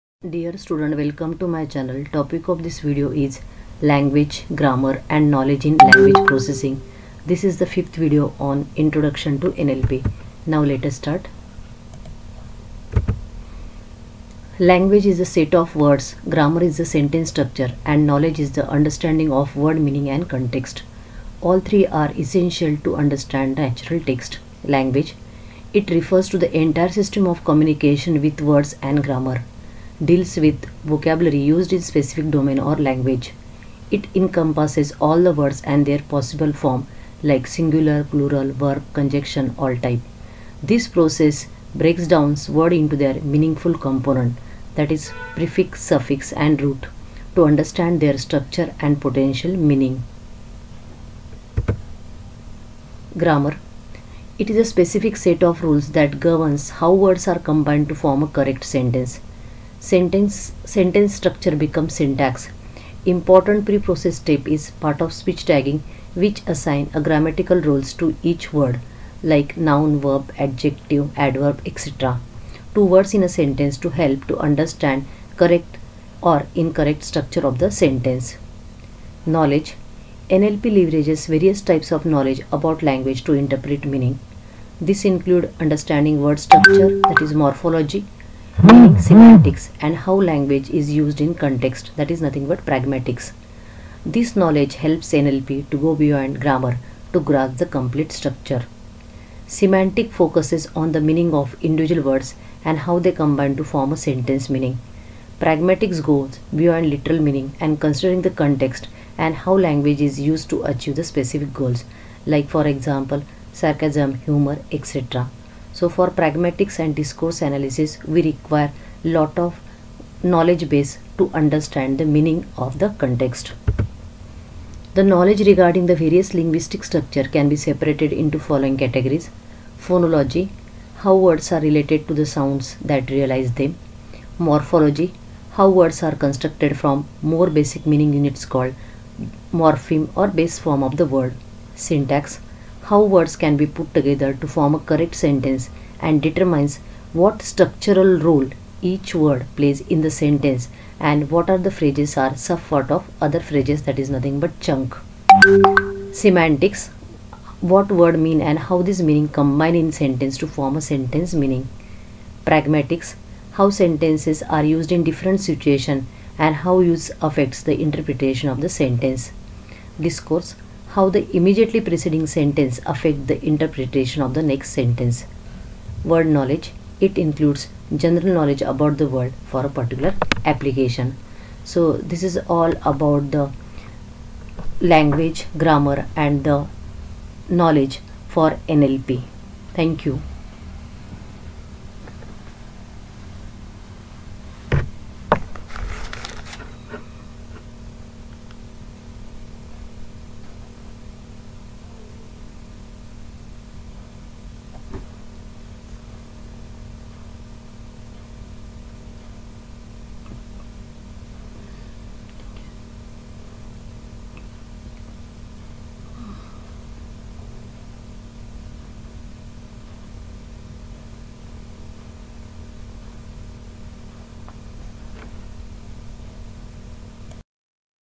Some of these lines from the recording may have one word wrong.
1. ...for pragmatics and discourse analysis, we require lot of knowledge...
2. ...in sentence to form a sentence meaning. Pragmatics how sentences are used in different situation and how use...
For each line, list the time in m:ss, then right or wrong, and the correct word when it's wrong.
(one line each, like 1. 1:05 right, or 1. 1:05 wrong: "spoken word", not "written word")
1. 1:55 right
2. 2:39 right.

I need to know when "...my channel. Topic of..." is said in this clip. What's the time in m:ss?
0:01.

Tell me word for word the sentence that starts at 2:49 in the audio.
Discourse how the immediately preceding sentence affect the interpretation of the next sentence.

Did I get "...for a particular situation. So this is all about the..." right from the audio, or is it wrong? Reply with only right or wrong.
wrong.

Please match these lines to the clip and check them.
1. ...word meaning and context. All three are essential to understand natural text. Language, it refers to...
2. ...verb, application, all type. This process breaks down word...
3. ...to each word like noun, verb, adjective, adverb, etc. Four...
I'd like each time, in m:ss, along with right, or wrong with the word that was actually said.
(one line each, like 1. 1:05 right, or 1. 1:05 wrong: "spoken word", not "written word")
1. 0:19 right
2. 0:38 wrong: "conjunction", not "application"
3. 1:08 wrong: "Two", not "Four".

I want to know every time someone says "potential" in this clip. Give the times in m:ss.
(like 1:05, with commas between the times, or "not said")
0:48.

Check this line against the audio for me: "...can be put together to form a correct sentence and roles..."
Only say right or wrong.
wrong.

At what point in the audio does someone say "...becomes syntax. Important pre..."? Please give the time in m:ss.
1:01.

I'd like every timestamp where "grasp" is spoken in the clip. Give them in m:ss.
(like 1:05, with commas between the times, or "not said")
1:37.